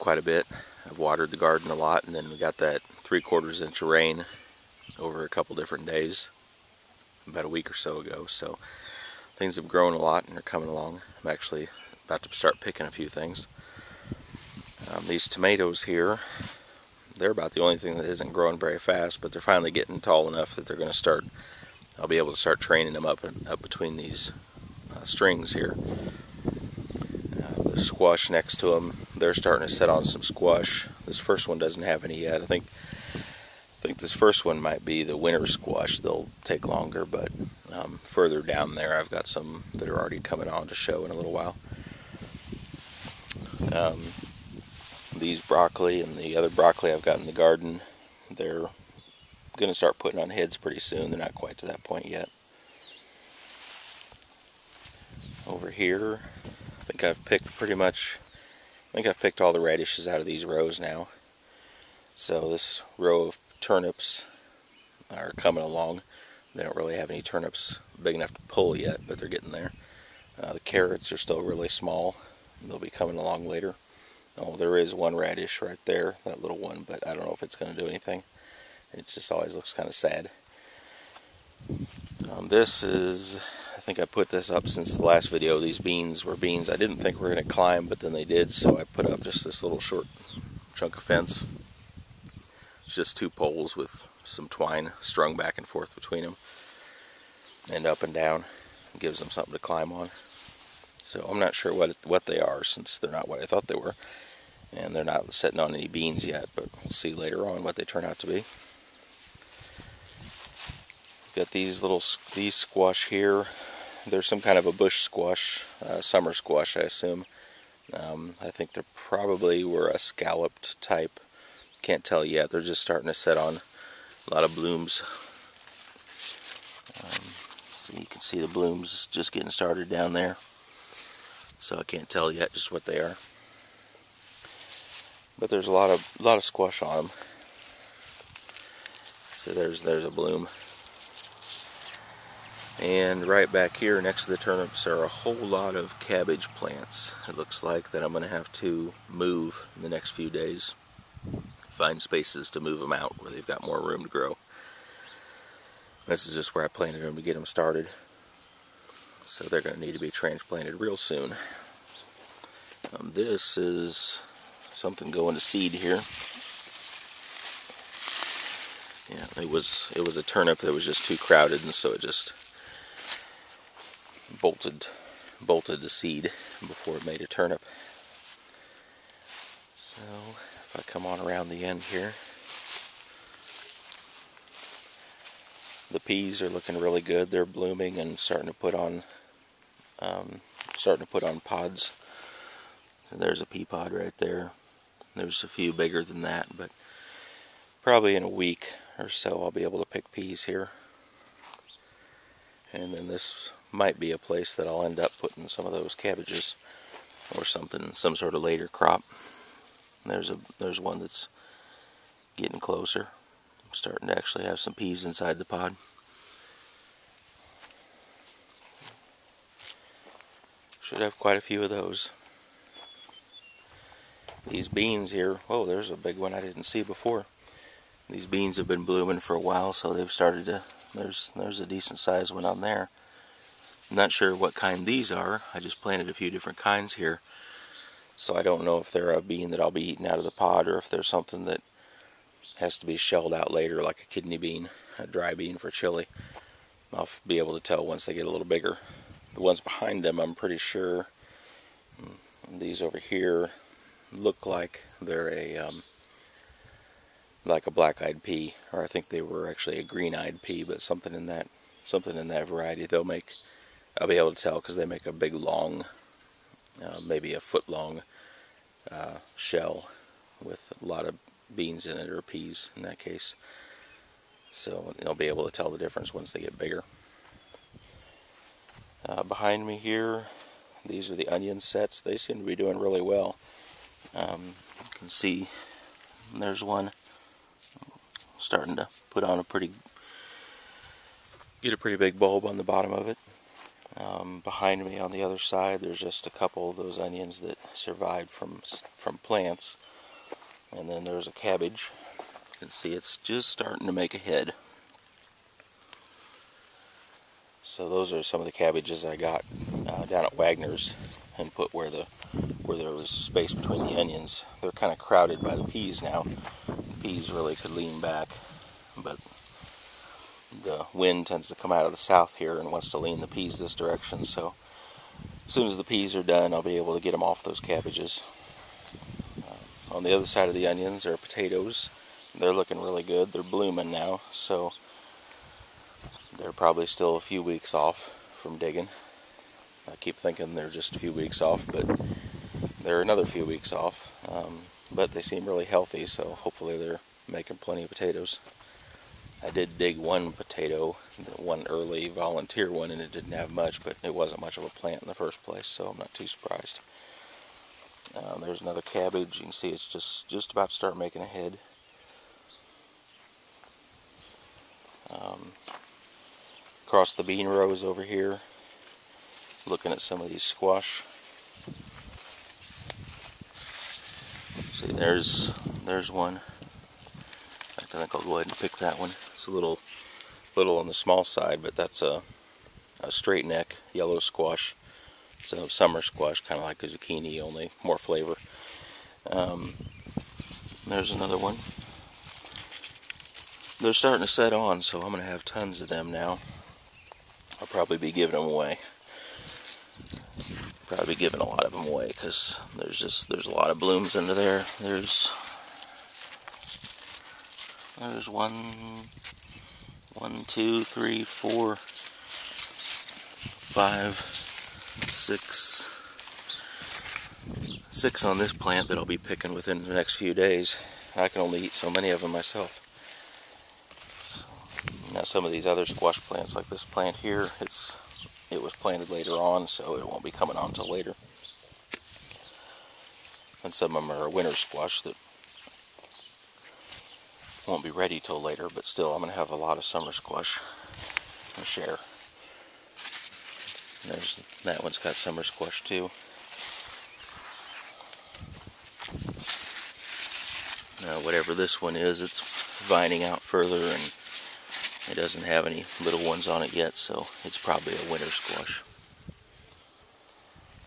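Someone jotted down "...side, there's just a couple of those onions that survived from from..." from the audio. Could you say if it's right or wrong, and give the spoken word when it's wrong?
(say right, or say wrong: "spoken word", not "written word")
right.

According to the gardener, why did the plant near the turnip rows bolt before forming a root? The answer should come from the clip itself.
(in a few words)
too crowded.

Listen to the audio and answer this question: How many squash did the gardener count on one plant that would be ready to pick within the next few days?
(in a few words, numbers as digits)
6.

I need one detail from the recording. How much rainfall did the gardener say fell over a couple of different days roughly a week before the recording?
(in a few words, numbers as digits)
3/4 inch.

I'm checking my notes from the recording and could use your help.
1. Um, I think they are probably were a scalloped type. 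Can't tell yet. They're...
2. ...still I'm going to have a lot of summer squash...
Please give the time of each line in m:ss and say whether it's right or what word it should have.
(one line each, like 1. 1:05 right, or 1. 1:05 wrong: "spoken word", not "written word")
1. 1:57 right
2. 7:18 right.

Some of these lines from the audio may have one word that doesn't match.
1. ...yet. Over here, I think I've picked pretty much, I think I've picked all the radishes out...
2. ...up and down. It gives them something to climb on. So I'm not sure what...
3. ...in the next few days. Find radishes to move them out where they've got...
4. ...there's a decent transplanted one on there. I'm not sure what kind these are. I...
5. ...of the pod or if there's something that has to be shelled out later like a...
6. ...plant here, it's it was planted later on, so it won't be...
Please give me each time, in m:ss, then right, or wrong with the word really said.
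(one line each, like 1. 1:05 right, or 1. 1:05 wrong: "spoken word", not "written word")
1. 0:52 right
2. 1:37 right
3. 2:29 wrong: "spaces", not "radishes"
4. 3:51 wrong: "sized", not "transplanted"
5. 4:00 right
6. 7:06 right.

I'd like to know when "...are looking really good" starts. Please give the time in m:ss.
3:06.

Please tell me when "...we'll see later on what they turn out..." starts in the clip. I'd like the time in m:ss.
1:46.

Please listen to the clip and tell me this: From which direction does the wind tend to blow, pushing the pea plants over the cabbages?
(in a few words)
south.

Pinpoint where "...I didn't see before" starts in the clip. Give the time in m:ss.
3:46.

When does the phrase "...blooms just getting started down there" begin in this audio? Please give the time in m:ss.
2:08.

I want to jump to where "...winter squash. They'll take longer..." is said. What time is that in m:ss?
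0:35.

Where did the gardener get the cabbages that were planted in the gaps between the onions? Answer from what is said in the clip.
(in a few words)
Wagner's.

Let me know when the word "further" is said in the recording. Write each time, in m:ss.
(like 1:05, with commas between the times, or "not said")
0:38, 7:33.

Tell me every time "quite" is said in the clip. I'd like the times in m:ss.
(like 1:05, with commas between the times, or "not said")
0:51, 3:41.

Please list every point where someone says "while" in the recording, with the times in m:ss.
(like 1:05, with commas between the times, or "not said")
0:41, 3:49.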